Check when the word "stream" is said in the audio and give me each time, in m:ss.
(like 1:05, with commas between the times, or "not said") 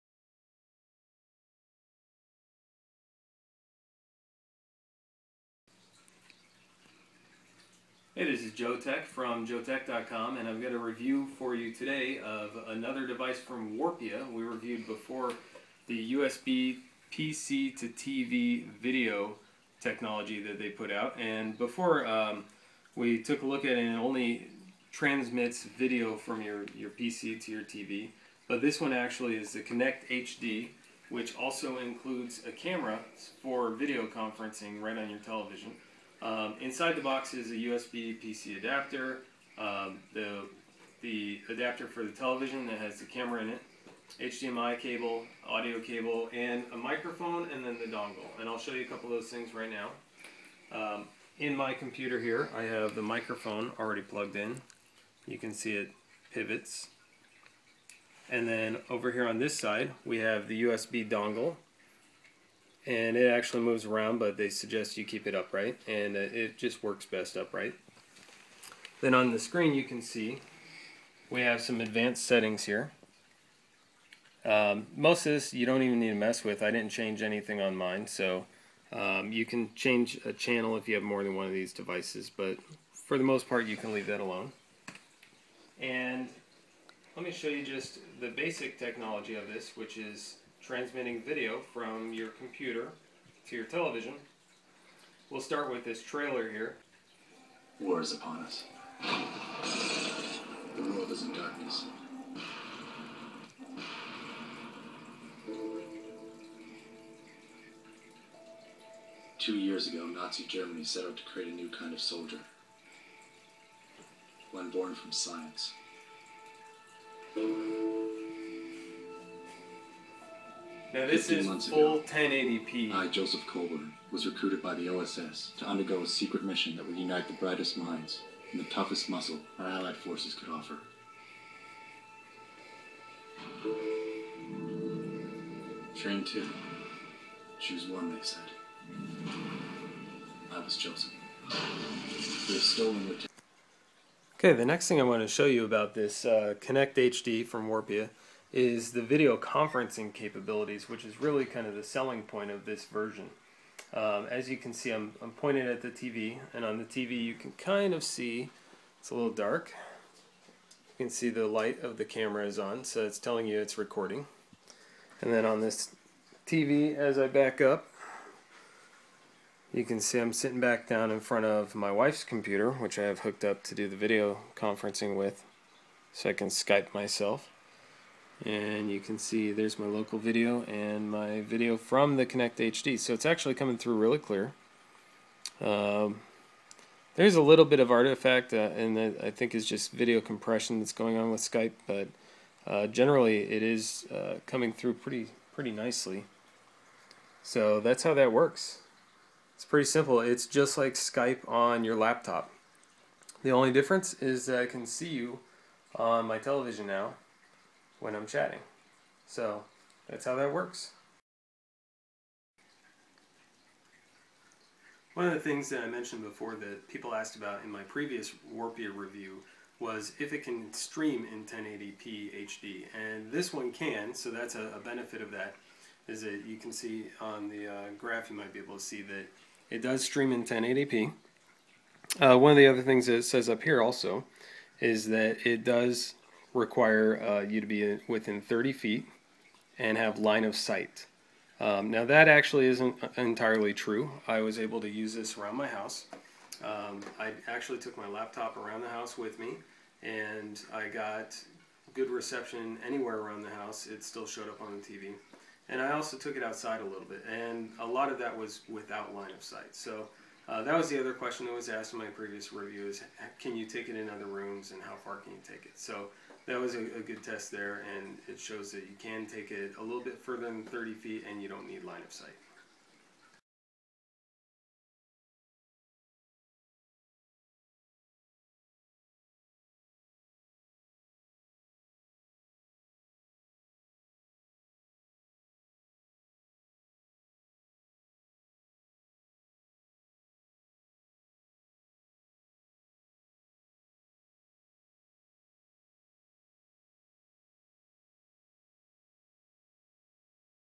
3:40, 3:50.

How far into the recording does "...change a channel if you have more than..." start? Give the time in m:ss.
1:19.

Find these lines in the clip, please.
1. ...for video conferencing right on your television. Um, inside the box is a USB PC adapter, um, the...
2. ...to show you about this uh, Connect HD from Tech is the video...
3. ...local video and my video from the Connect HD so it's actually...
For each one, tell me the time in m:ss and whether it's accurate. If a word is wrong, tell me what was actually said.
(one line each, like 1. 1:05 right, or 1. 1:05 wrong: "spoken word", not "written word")
1. 0:33 right
2. 2:25 wrong: "Warpia", not "Tech"
3. 2:59 right.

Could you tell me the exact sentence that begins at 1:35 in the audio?
We'll start with this trailer here.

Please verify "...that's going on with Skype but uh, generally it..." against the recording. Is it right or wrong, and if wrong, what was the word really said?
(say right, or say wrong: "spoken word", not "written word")
right.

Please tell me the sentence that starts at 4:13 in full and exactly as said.
It still showed up on the TV.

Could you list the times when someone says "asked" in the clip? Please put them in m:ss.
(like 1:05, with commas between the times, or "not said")
3:37, 4:21.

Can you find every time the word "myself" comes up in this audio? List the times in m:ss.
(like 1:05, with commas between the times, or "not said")
2:56.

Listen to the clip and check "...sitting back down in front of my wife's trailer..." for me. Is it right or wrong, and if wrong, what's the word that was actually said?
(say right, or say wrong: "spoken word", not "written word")
wrong: "computer", not "trailer".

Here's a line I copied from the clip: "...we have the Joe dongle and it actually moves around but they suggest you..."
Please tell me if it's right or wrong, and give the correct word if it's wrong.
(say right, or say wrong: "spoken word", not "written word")
wrong: "USB", not "Joe".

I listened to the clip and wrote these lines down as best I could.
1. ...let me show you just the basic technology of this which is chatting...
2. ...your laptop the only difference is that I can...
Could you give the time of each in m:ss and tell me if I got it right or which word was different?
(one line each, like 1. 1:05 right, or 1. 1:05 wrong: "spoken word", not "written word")
1. 1:27 wrong: "transmitting", not "chatting"
2. 3:21 right.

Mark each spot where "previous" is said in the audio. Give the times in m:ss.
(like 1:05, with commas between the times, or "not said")
3:37, 4:22.